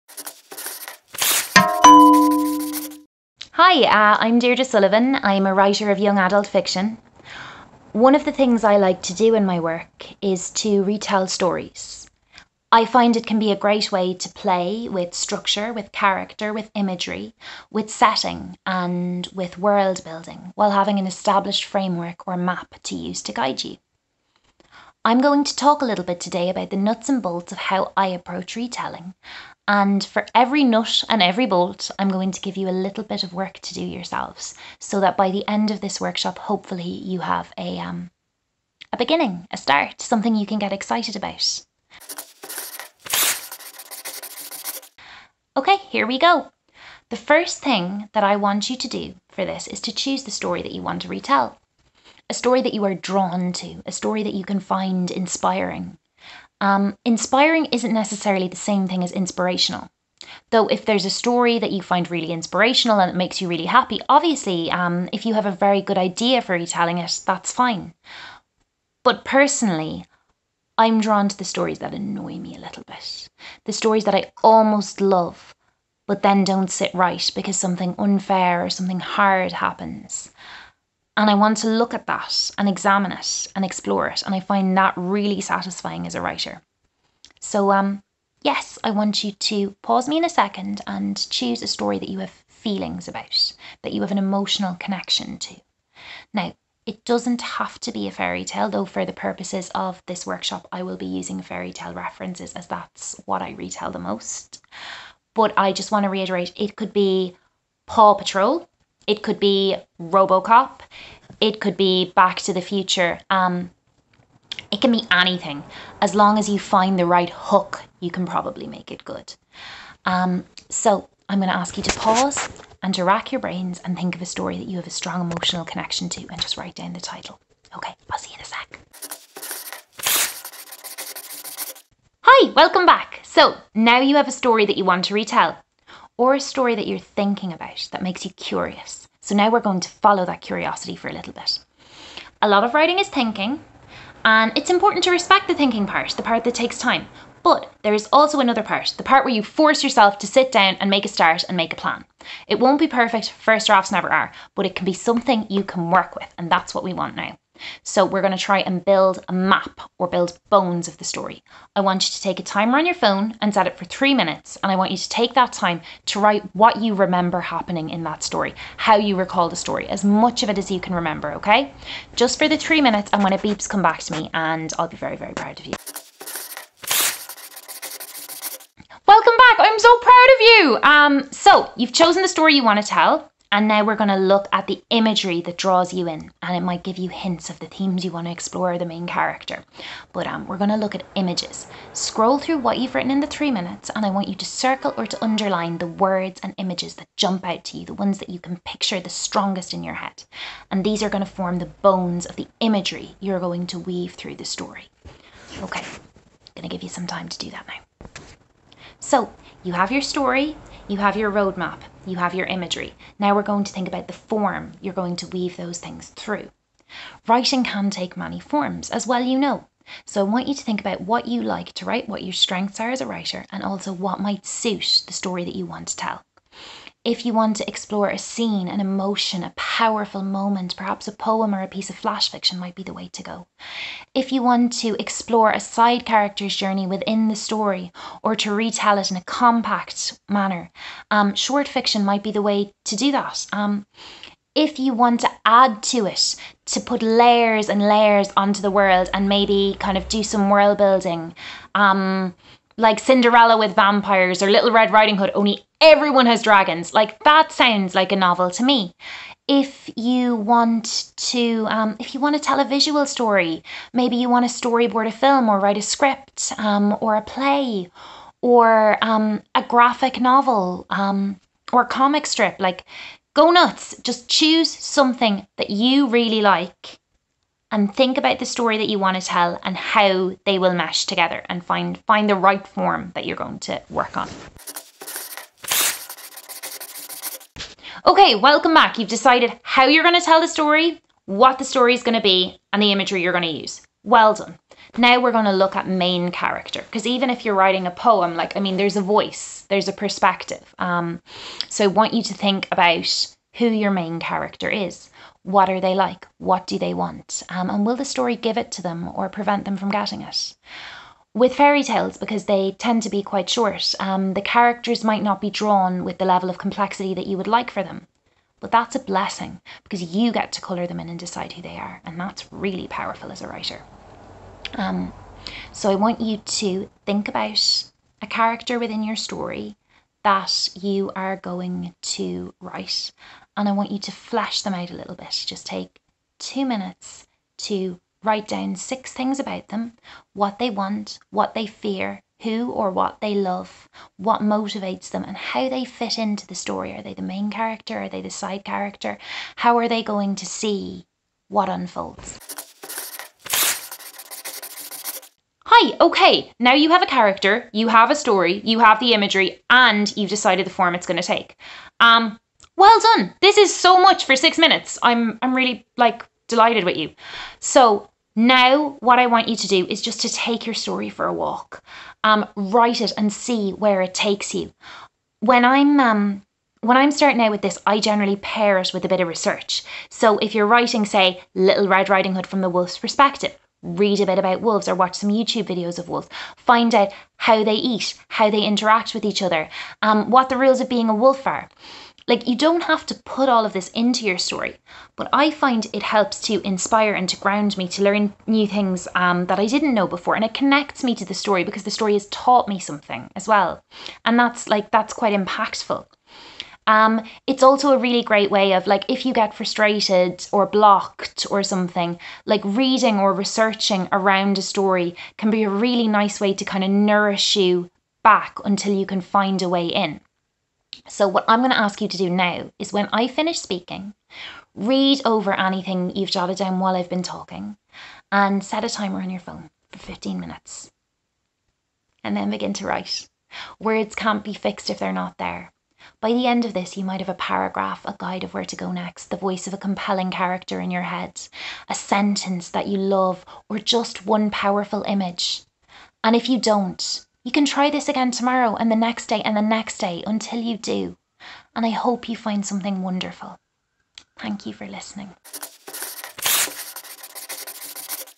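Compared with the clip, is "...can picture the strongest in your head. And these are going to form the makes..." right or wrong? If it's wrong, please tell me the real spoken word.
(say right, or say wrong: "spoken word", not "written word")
wrong: "bones", not "makes".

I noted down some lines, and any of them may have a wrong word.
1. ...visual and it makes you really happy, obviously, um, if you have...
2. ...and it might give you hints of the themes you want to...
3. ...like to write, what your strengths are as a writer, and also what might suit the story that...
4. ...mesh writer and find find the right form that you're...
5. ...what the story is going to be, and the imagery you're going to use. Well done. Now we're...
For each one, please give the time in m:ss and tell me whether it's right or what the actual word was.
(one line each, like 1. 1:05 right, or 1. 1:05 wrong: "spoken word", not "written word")
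1. 1:02 wrong: "inspirational", not "visual"
2. 3:06 right
3. 3:41 right
4. 4:40 wrong: "together", not "writer"
5. 4:51 right.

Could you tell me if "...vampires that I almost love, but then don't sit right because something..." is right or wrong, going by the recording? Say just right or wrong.
wrong.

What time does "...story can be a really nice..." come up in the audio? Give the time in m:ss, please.
6:54.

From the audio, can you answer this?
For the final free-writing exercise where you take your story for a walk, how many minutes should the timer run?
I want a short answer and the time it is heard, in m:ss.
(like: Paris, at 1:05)
15 minutes, at 7:09.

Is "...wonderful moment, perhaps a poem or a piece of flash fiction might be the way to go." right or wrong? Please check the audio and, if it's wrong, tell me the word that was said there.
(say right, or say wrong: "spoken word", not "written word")
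wrong: "powerful", not "wonderful".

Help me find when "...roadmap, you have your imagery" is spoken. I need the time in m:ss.
3:31.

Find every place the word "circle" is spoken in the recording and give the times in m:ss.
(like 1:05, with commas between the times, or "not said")
3:14.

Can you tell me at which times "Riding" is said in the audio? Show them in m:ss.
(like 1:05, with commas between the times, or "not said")
4:14, 6:22.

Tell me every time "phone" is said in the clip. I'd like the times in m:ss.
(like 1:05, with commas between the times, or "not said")
2:42, 7:09.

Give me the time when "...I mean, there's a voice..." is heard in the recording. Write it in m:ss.
4:58.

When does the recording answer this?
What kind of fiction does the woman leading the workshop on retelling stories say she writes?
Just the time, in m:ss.
0:05.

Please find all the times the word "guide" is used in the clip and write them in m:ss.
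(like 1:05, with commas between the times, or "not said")
0:23, 7:18.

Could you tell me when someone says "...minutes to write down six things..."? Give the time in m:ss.
5:36.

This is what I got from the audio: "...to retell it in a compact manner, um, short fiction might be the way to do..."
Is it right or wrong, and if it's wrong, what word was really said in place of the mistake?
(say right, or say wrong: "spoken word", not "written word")
right.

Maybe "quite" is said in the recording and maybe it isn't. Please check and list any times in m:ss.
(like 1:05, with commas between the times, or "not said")
5:13, 6:45.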